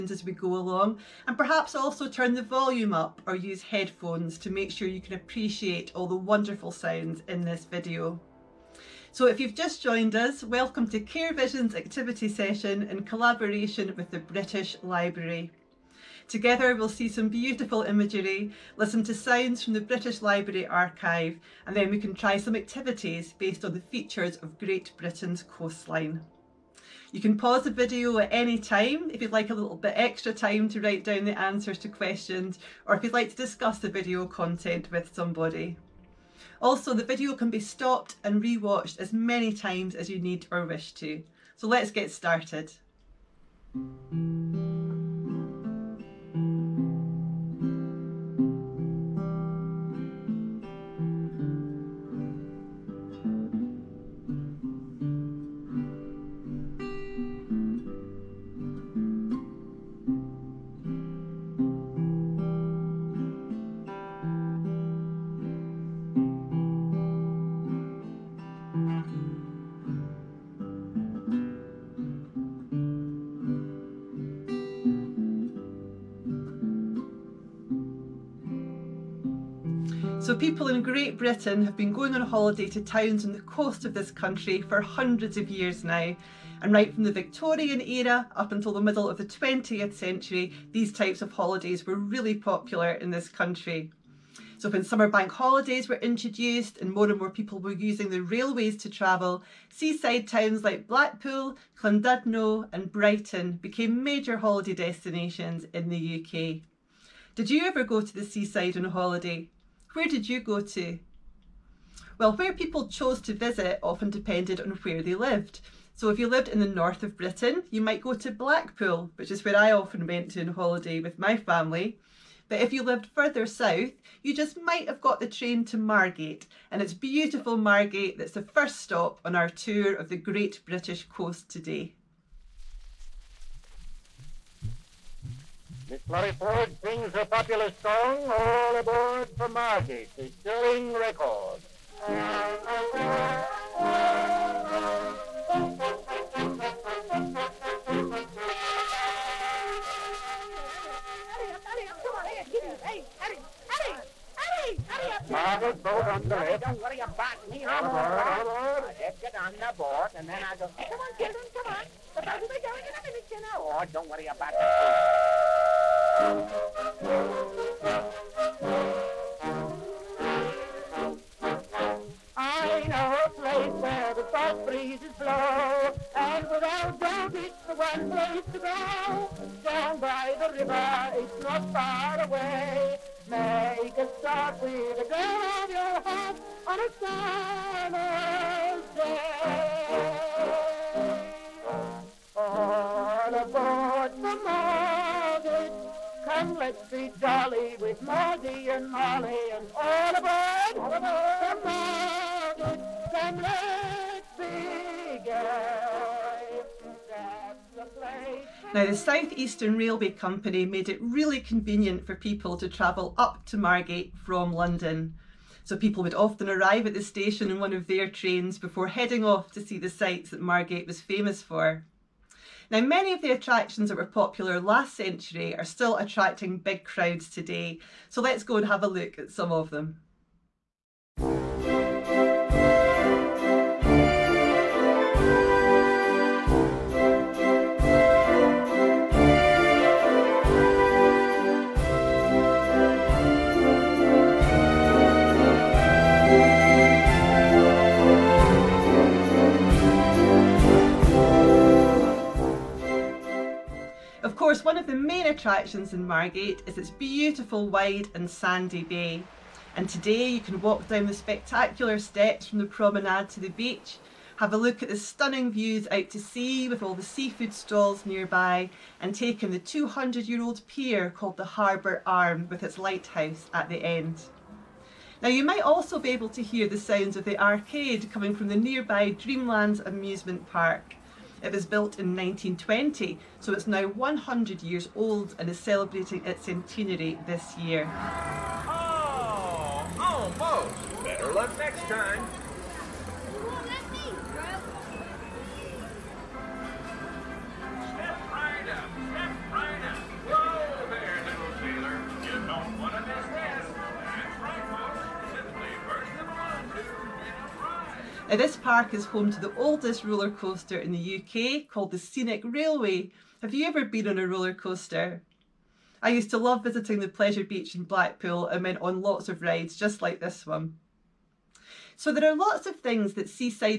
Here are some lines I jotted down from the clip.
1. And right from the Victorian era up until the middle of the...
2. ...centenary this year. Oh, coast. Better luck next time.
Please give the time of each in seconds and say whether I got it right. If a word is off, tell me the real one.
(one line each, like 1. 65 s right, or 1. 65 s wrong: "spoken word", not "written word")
1. 86 s right
2. 286 s wrong: "almost", not "coast".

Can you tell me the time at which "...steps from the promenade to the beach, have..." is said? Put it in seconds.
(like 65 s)
261 s.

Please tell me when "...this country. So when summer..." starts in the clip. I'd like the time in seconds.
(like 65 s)
93 s.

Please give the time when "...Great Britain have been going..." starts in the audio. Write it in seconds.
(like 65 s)
80 s.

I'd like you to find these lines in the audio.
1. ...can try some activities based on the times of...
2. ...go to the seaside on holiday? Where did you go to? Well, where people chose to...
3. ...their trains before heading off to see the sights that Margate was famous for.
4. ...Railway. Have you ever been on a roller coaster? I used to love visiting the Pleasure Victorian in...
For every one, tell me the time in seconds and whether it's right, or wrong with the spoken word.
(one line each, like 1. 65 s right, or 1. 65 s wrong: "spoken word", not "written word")
1. 21 s wrong: "features", not "times"
2. 107 s right
3. 217 s right
4. 312 s wrong: "Beach", not "Victorian".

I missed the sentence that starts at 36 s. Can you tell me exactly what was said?
Also, the video can be stopped and rewatched as many times as you need or wish to.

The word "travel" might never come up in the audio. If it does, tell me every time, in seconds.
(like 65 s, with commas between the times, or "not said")
98 s, 212 s.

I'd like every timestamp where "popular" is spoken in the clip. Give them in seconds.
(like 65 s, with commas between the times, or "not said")
92 s, 137 s, 224 s.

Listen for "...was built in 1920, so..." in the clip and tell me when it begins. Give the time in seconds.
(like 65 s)
281 s.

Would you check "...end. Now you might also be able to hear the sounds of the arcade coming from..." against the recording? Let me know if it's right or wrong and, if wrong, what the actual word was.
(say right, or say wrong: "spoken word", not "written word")
right.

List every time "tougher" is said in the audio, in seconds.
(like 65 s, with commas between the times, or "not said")
not said.